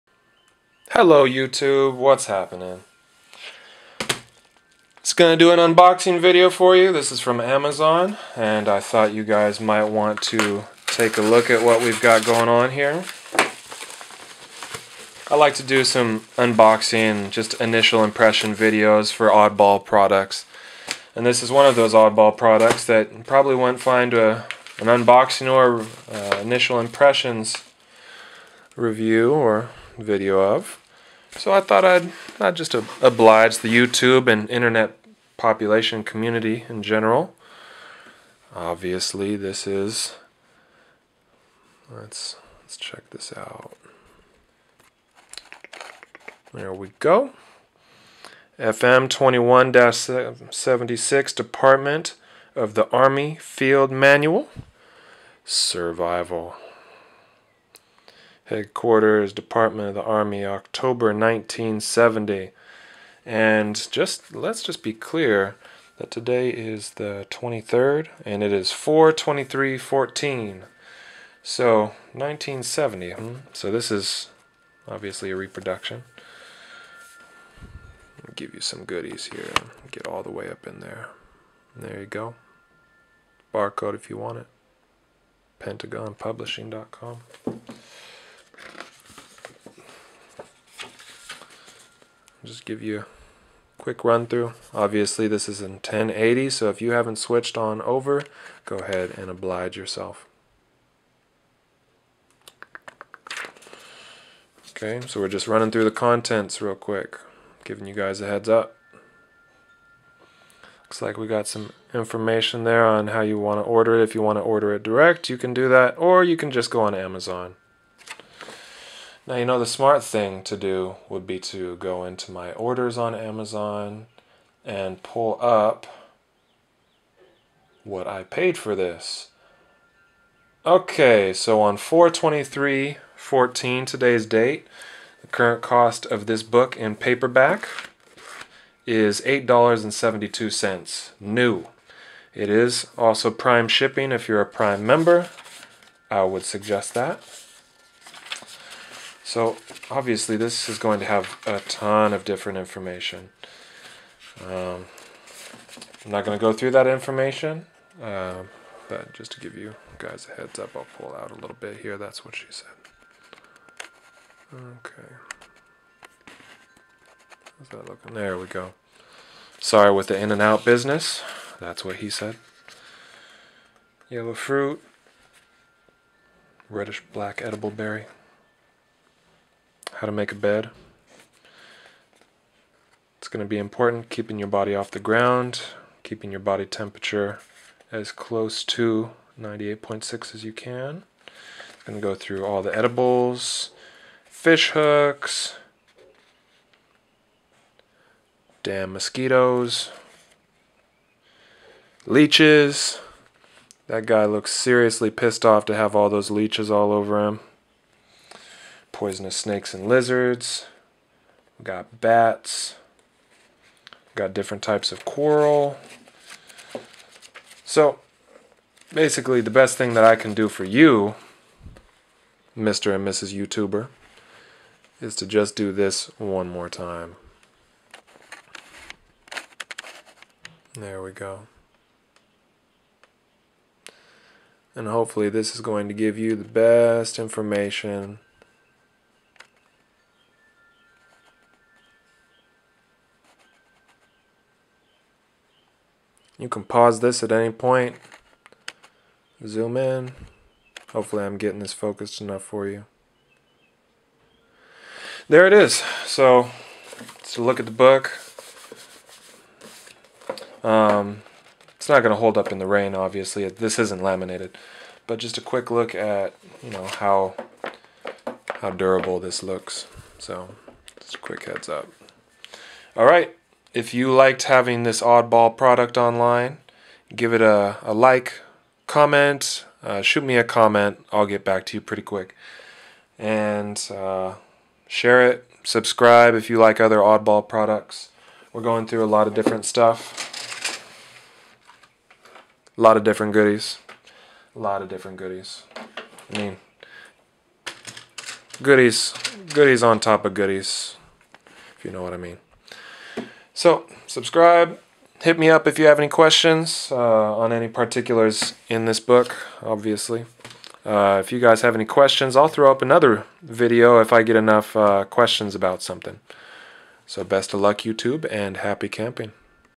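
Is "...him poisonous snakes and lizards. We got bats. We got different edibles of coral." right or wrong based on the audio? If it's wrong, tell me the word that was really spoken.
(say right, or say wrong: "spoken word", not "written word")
wrong: "types", not "edibles".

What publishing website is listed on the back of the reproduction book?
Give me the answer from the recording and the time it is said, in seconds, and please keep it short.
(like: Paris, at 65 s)
PentagonPublishing.com, at 85 s.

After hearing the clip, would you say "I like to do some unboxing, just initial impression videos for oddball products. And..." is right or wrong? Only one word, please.
right.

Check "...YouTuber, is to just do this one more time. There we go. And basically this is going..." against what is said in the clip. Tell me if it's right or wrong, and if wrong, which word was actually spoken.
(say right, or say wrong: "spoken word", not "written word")
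wrong: "hopefully", not "basically".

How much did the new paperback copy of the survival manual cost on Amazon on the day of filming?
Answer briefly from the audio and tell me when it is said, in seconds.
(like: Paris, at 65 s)
$8.72, at 139 s.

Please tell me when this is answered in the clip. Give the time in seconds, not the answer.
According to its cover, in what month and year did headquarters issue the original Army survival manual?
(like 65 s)
60 s.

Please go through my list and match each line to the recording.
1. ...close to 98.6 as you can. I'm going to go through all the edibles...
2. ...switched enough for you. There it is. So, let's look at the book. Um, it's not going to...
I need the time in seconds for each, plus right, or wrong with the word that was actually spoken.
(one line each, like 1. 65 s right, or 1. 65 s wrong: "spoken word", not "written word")
1. 188 s right
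2. 251 s wrong: "focused", not "switched".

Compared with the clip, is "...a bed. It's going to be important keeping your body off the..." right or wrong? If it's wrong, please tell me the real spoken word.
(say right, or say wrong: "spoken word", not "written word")
right.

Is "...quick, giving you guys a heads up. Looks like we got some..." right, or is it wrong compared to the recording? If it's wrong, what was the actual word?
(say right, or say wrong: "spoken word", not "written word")
right.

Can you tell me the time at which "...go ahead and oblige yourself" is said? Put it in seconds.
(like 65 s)
98 s.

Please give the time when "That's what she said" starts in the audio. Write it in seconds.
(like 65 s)
161 s.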